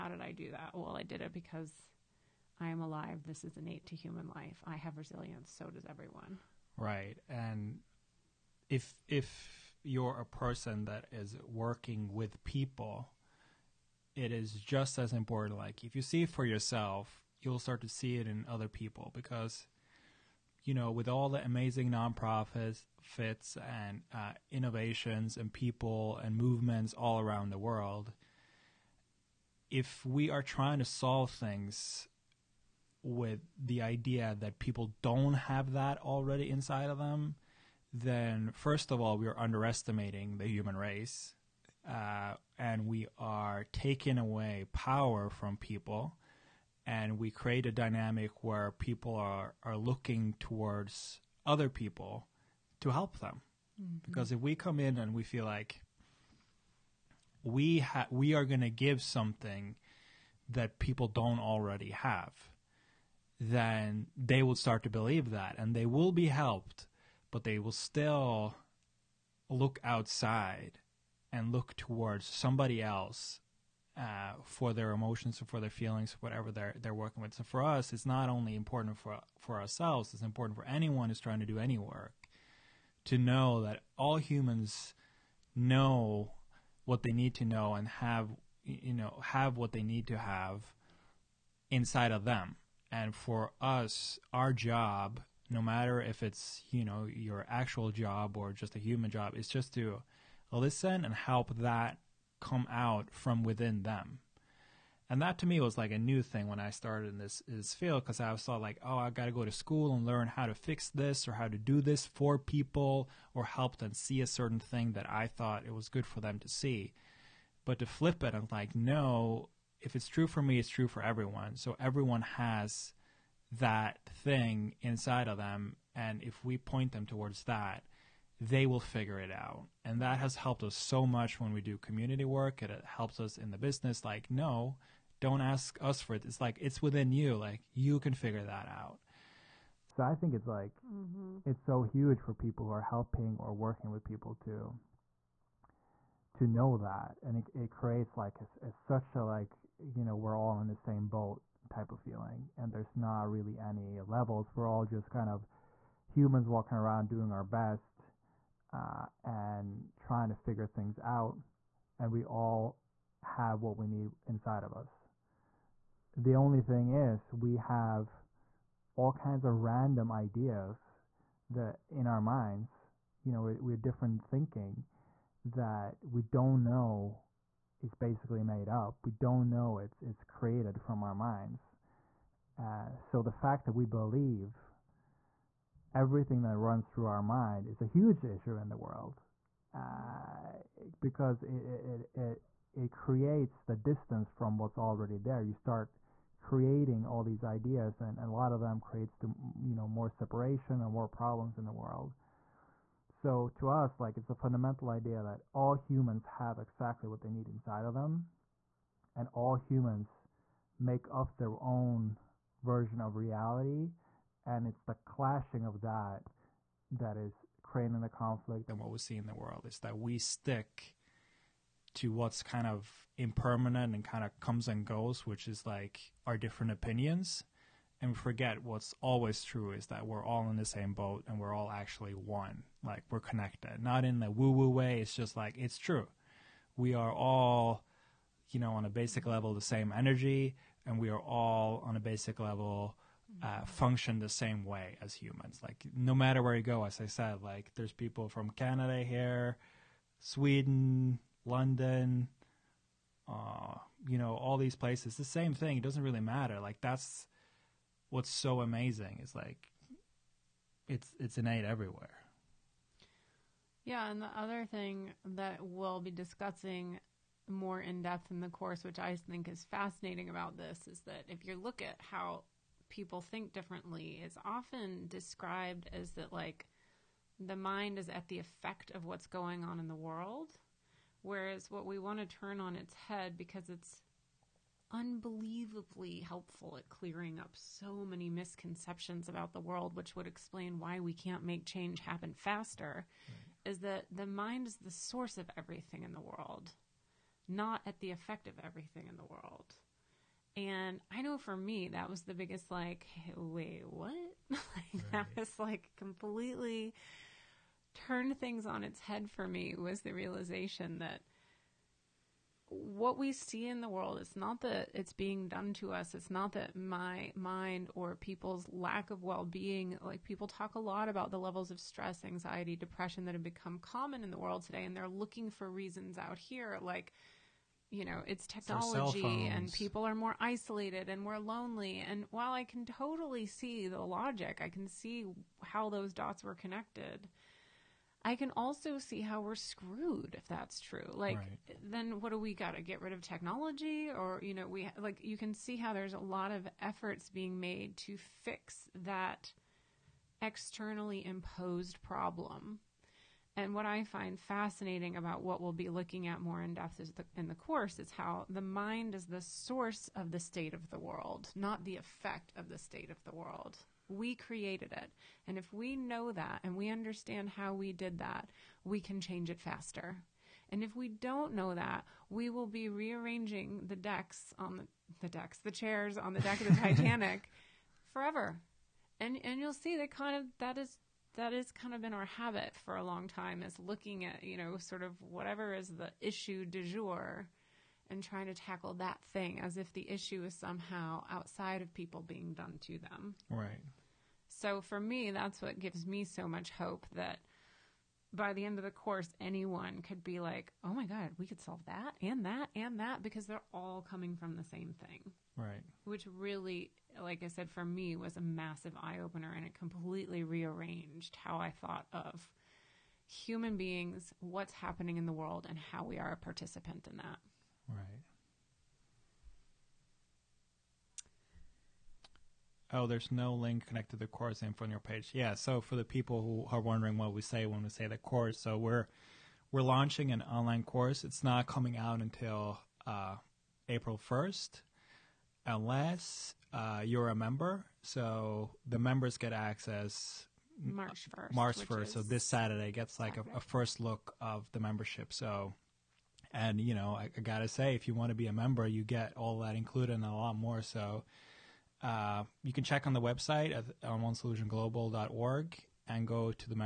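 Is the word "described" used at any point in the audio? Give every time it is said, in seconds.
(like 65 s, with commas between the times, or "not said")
275 s.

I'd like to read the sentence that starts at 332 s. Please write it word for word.
And while I can totally see the logic, I can see how those dots were connected.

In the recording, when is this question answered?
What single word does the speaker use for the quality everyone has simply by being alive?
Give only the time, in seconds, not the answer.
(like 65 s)
4 s.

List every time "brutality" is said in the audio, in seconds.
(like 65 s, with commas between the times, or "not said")
not said.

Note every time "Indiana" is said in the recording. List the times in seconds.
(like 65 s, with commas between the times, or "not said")
not said.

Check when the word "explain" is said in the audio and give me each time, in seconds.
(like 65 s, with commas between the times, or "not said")
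290 s.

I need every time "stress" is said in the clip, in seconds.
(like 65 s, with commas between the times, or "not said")
321 s.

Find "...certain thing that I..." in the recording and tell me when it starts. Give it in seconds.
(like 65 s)
114 s.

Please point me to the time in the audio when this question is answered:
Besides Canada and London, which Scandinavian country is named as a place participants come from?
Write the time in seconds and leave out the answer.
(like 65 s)
250 s.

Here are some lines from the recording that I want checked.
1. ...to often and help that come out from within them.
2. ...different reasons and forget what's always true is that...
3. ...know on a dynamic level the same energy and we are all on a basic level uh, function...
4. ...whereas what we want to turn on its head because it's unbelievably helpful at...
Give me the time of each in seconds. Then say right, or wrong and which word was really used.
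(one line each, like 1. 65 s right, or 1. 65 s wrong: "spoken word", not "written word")
1. 99 s wrong: "listen", not "often"
2. 226 s wrong: "opinions", not "reasons"
3. 238 s wrong: "basic", not "dynamic"
4. 281 s right.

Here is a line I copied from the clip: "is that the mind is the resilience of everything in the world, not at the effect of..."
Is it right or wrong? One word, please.
wrong.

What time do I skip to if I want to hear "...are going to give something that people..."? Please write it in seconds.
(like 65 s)
58 s.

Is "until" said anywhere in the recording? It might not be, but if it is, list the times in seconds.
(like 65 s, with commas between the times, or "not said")
432 s.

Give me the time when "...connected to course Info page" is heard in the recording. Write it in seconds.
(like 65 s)
423 s.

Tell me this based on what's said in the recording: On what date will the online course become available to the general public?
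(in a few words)
April 1st.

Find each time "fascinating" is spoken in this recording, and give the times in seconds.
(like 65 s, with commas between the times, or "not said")
269 s, 354 s.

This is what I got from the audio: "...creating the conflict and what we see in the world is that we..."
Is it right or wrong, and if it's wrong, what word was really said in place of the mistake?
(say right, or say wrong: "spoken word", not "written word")
right.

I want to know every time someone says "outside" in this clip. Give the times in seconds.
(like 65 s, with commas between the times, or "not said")
69 s, 391 s.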